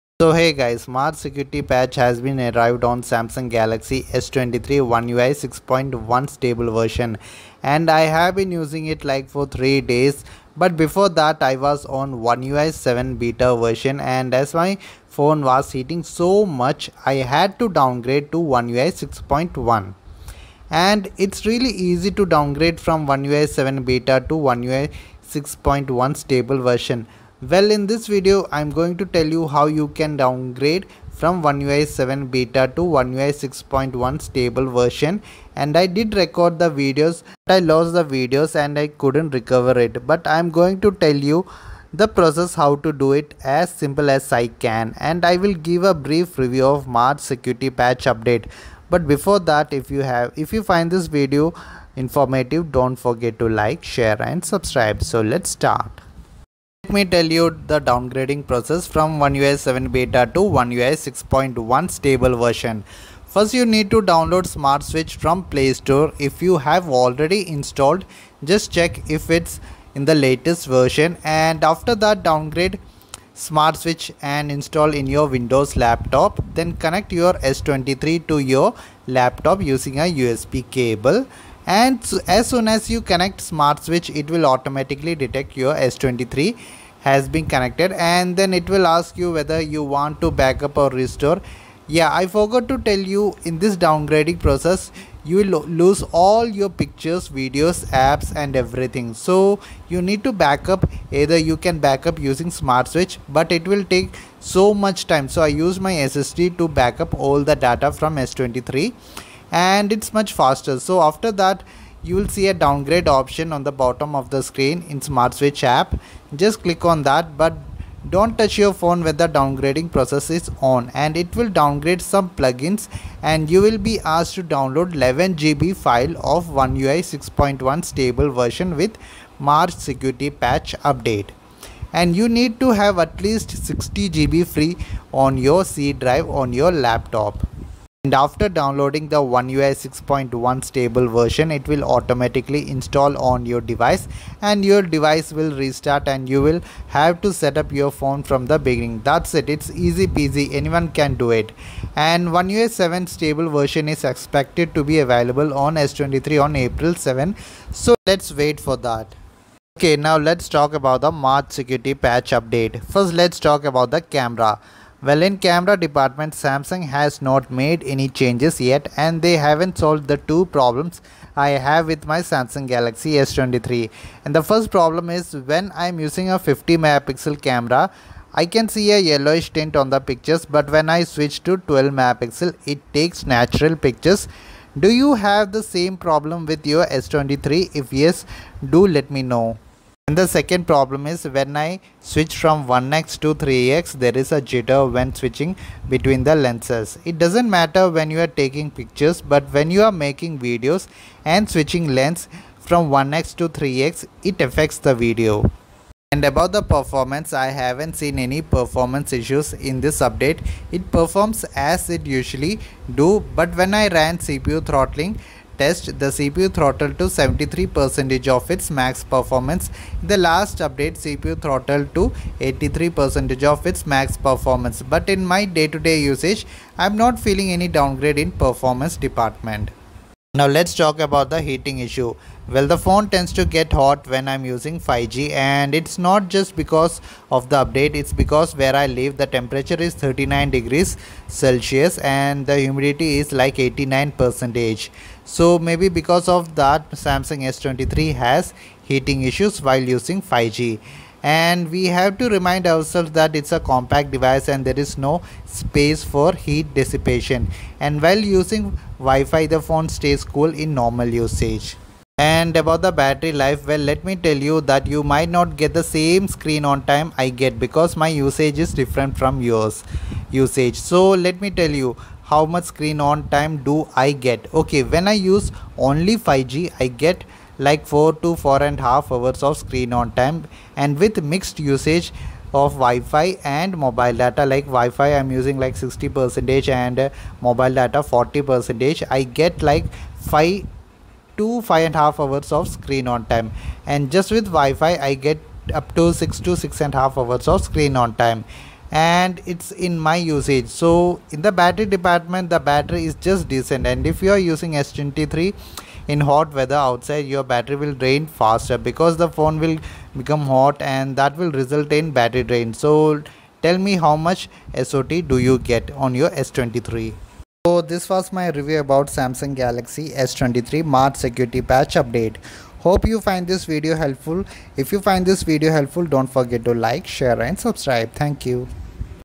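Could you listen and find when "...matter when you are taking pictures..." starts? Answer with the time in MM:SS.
03:17.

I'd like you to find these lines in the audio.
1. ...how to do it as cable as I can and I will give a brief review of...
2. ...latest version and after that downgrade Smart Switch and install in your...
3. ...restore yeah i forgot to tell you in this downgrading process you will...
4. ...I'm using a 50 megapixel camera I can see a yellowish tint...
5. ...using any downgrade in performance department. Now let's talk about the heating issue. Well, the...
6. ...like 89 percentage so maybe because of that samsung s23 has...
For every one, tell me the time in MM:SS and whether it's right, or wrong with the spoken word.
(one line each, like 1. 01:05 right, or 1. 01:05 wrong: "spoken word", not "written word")
1. 00:42 wrong: "simple", not "cable"
2. 01:10 right
3. 01:30 right
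4. 02:55 right
5. 03:47 wrong: "feeling", not "using"
6. 04:03 right.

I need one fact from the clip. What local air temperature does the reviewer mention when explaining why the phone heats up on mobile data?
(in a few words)
39 degrees Celsius.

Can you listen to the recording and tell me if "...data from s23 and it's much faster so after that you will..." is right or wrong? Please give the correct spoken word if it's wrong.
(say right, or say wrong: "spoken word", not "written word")
right.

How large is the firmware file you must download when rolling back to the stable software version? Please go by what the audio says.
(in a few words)
11 GB.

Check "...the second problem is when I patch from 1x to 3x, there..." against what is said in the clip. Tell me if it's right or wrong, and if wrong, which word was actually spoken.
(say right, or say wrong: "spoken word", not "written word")
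wrong: "switch", not "patch".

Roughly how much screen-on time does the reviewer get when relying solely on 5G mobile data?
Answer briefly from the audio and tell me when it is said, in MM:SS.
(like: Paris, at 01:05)
4 to 4.5 hours, at 04:37.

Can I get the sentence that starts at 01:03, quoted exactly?
First you need to download Smart Switch from Play Store.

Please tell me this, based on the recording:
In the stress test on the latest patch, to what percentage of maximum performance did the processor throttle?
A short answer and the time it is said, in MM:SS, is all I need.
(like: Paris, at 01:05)
73%, at 03:37.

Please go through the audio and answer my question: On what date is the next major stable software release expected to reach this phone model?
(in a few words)
April 7.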